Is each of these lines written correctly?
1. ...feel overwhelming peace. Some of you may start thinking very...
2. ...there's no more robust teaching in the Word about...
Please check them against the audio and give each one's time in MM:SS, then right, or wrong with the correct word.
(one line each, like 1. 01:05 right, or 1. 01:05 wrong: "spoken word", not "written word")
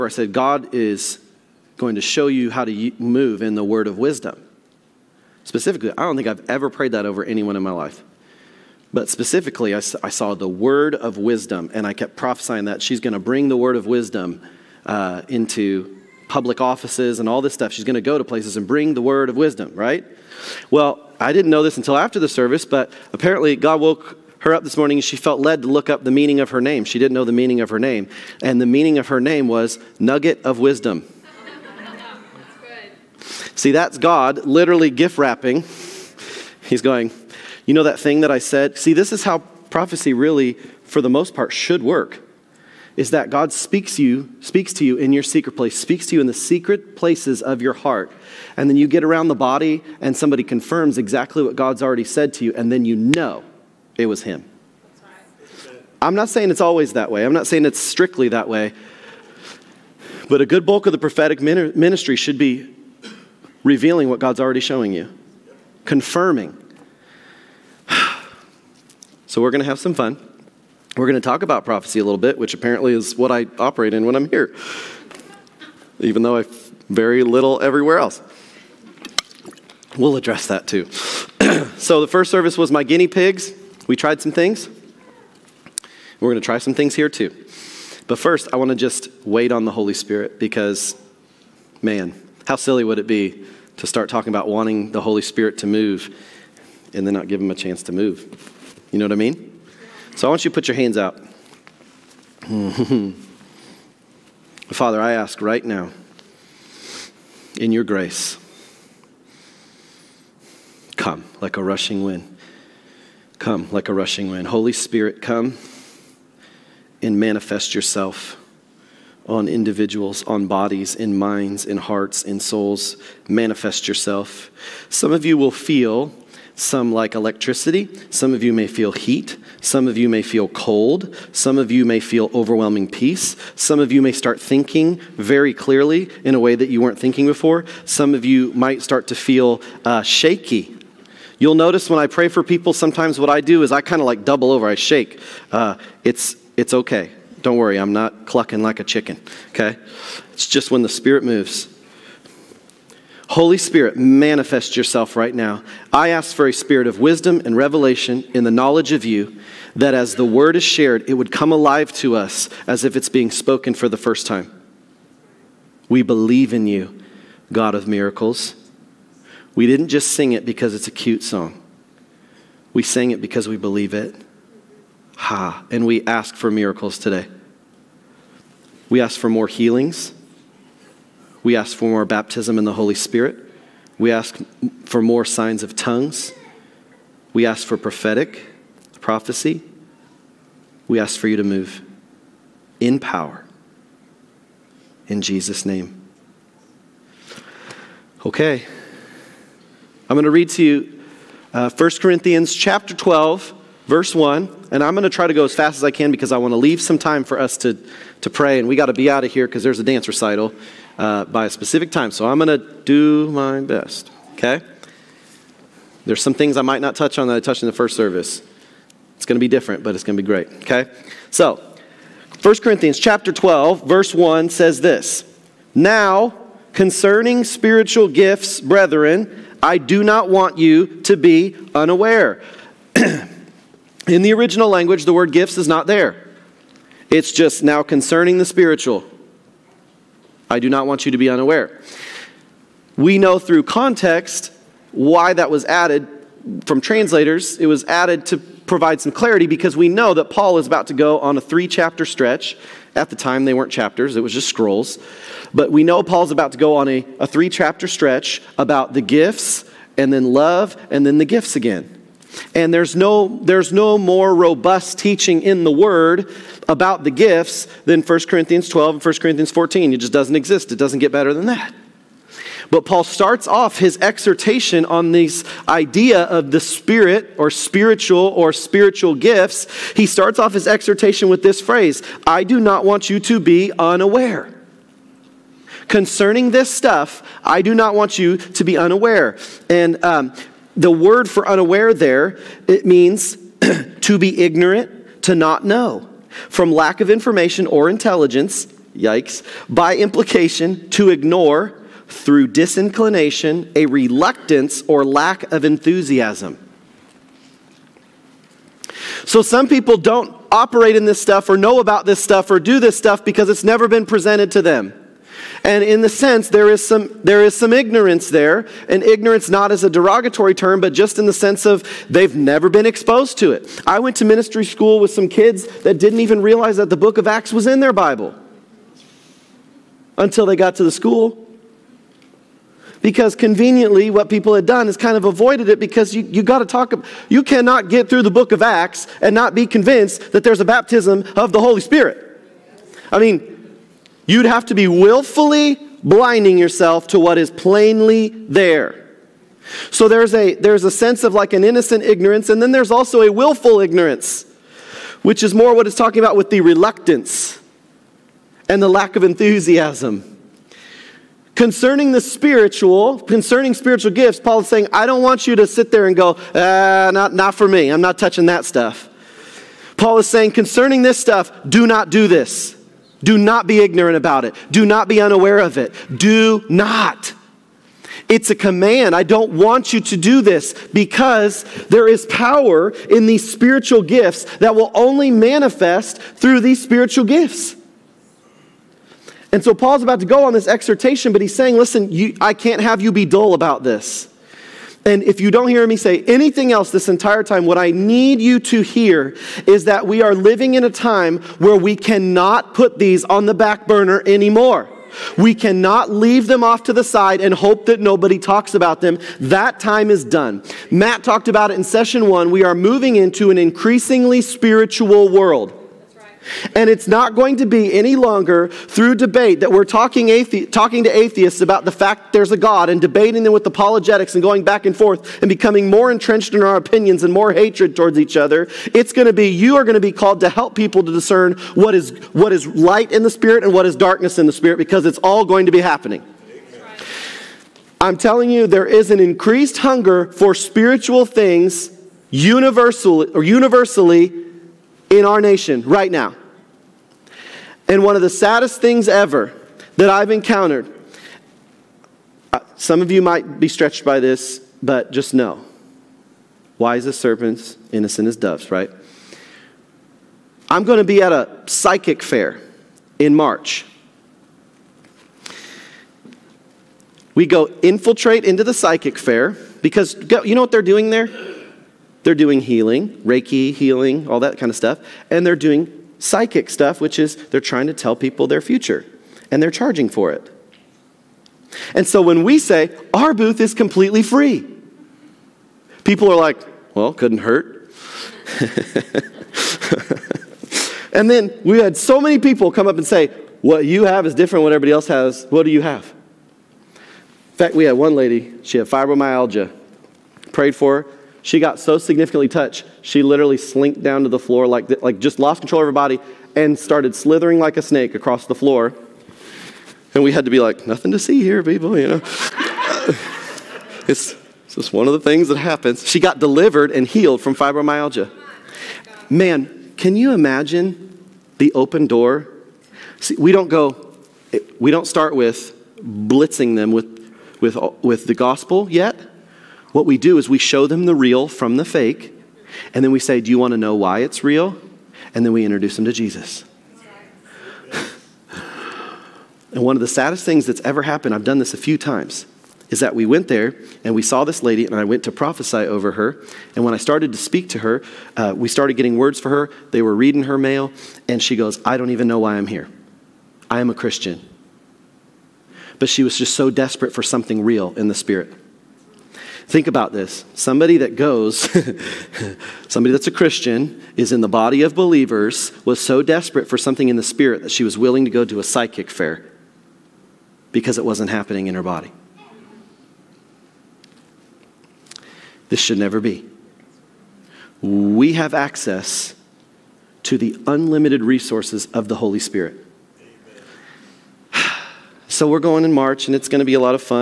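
1. 02:11 right
2. 04:23 right.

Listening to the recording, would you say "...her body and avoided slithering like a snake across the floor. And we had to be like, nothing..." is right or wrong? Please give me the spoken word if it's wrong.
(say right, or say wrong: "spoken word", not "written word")
wrong: "started", not "avoided".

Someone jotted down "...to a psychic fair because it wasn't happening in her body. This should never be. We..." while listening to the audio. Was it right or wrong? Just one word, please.
right.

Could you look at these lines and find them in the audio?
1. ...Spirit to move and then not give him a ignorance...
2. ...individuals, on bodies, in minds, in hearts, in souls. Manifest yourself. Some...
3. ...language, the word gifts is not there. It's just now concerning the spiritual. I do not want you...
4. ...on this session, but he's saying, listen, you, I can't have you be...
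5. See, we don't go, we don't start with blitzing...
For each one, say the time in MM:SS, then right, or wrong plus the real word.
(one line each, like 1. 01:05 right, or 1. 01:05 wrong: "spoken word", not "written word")
1. 01:35 wrong: "chance", not "ignorance"
2. 01:59 right
3. 03:54 right
4. 06:30 wrong: "exhortation", not "session"
5. 08:43 right.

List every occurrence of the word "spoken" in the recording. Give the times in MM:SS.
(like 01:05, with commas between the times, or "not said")
02:43.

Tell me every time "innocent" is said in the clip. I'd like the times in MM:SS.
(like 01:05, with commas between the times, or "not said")
05:51, 07:37.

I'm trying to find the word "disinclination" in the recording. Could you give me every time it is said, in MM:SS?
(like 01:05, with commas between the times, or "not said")
05:02.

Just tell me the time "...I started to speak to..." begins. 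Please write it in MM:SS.
09:06.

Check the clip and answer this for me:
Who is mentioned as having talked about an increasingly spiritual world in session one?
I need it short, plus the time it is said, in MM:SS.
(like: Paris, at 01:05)
Matt, at 06:50.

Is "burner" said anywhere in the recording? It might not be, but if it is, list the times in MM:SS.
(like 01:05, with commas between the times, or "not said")
06:43.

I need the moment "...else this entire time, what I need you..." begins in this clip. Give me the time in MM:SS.
06:36.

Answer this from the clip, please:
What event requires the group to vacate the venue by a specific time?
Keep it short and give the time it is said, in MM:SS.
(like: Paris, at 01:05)
A dance recital, at 03:29.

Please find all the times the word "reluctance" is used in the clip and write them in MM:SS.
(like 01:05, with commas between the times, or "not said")
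05:03, 05:56.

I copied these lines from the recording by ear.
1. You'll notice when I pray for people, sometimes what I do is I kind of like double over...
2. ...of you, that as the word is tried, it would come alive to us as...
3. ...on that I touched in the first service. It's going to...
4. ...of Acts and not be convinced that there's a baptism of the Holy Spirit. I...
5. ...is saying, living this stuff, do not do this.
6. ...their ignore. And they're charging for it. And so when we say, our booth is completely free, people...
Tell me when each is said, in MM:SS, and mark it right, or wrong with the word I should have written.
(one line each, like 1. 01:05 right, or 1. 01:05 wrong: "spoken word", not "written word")
1. 02:21 right
2. 02:38 wrong: "shared", not "tried"
3. 03:37 right
4. 05:38 right
5. 06:10 wrong: "concerning", not "living"
6. 07:58 wrong: "future", not "ignore".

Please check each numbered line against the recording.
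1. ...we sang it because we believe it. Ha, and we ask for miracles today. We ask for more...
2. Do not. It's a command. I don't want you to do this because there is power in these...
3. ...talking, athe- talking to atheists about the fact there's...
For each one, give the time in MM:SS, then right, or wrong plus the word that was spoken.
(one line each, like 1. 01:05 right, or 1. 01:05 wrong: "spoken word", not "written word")
1. 02:52 right
2. 06:16 right
3. 06:59 right.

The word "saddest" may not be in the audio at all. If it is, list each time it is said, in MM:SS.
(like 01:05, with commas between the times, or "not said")
07:28, 09:00.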